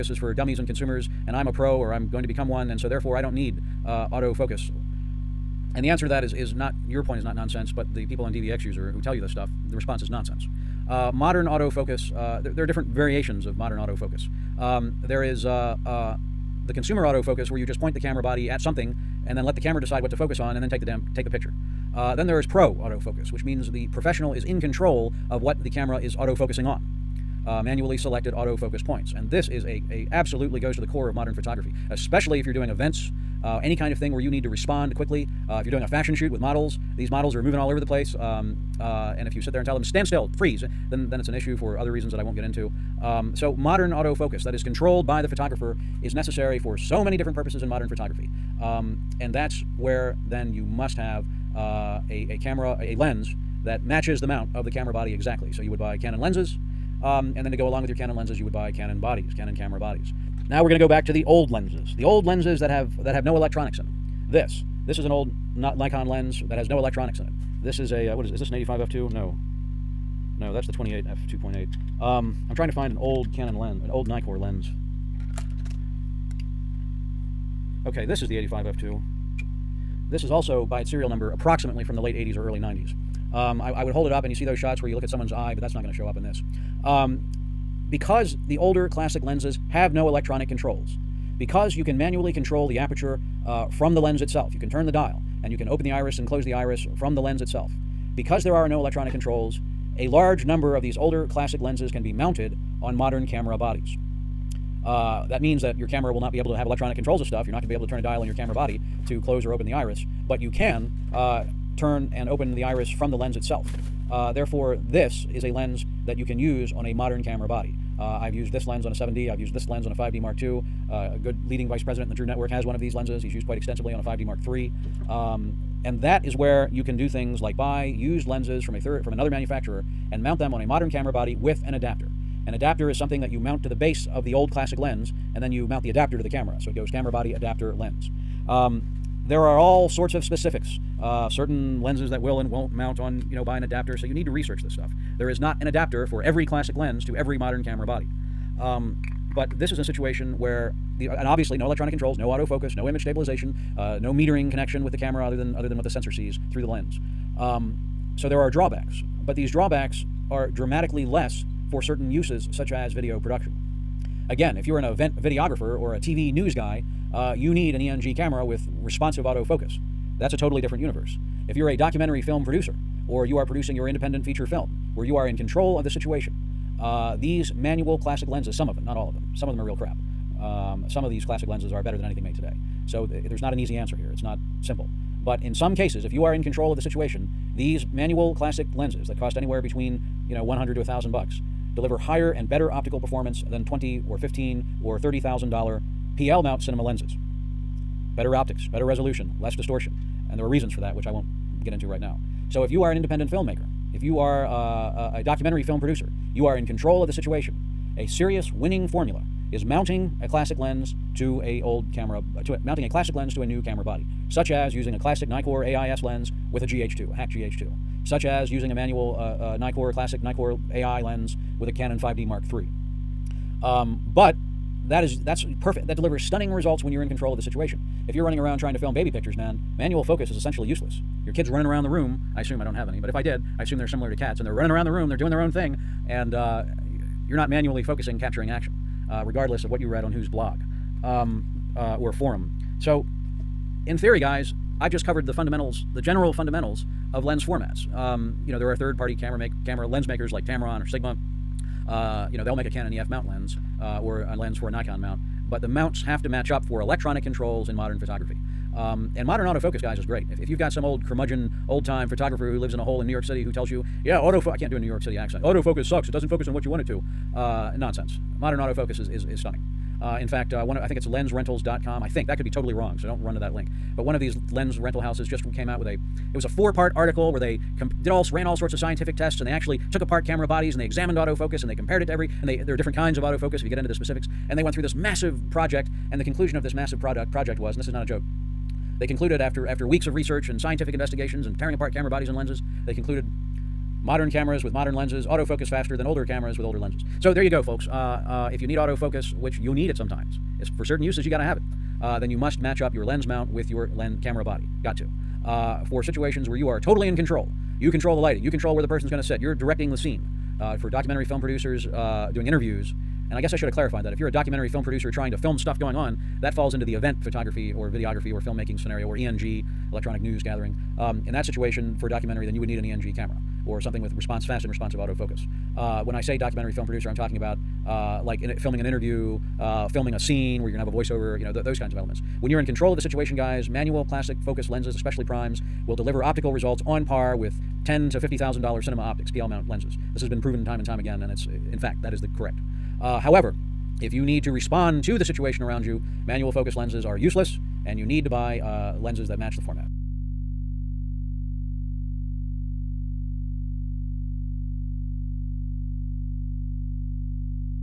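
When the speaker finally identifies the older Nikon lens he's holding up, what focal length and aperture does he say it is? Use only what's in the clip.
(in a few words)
85 f2.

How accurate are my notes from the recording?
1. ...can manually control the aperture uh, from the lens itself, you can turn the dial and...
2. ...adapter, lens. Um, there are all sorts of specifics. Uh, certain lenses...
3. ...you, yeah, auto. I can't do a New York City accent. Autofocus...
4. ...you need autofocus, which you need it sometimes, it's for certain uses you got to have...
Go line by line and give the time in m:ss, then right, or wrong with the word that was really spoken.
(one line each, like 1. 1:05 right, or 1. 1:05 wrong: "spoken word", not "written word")
1. 1:31 right
2. 2:17 right
3. 4:23 right
4. 4:58 right.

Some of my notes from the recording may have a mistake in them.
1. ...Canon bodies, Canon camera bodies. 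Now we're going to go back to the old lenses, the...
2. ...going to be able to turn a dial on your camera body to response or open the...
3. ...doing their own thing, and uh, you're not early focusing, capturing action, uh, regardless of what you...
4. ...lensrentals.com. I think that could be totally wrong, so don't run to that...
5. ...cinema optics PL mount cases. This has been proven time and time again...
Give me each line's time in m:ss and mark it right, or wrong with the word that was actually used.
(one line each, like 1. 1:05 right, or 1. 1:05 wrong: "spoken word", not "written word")
1. 0:58 right
2. 1:47 wrong: "close", not "response"
3. 3:55 wrong: "manually", not "early"
4. 4:31 right
5. 5:38 wrong: "lenses", not "cases".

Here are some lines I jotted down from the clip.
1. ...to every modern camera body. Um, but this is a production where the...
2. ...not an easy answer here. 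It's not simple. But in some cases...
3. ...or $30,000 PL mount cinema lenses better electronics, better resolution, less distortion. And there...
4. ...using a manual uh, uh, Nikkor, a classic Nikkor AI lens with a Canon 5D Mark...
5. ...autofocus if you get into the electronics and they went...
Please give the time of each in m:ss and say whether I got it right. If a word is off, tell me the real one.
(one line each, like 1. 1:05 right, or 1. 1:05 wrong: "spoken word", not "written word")
1. 2:27 wrong: "situation", not "production"
2. 3:03 right
3. 3:14 wrong: "optics", not "electronics"
4. 3:38 right
5. 4:43 wrong: "specifics", not "electronics".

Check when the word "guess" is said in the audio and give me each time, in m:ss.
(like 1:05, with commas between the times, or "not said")
5:13.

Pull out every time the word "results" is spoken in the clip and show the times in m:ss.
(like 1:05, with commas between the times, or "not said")
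3:46, 5:36.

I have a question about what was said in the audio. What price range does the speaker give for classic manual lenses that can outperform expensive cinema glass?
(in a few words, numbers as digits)
$100 to $1000.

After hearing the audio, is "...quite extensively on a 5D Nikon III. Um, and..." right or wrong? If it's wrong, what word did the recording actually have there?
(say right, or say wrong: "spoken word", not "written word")
wrong: "Mark", not "Nikon".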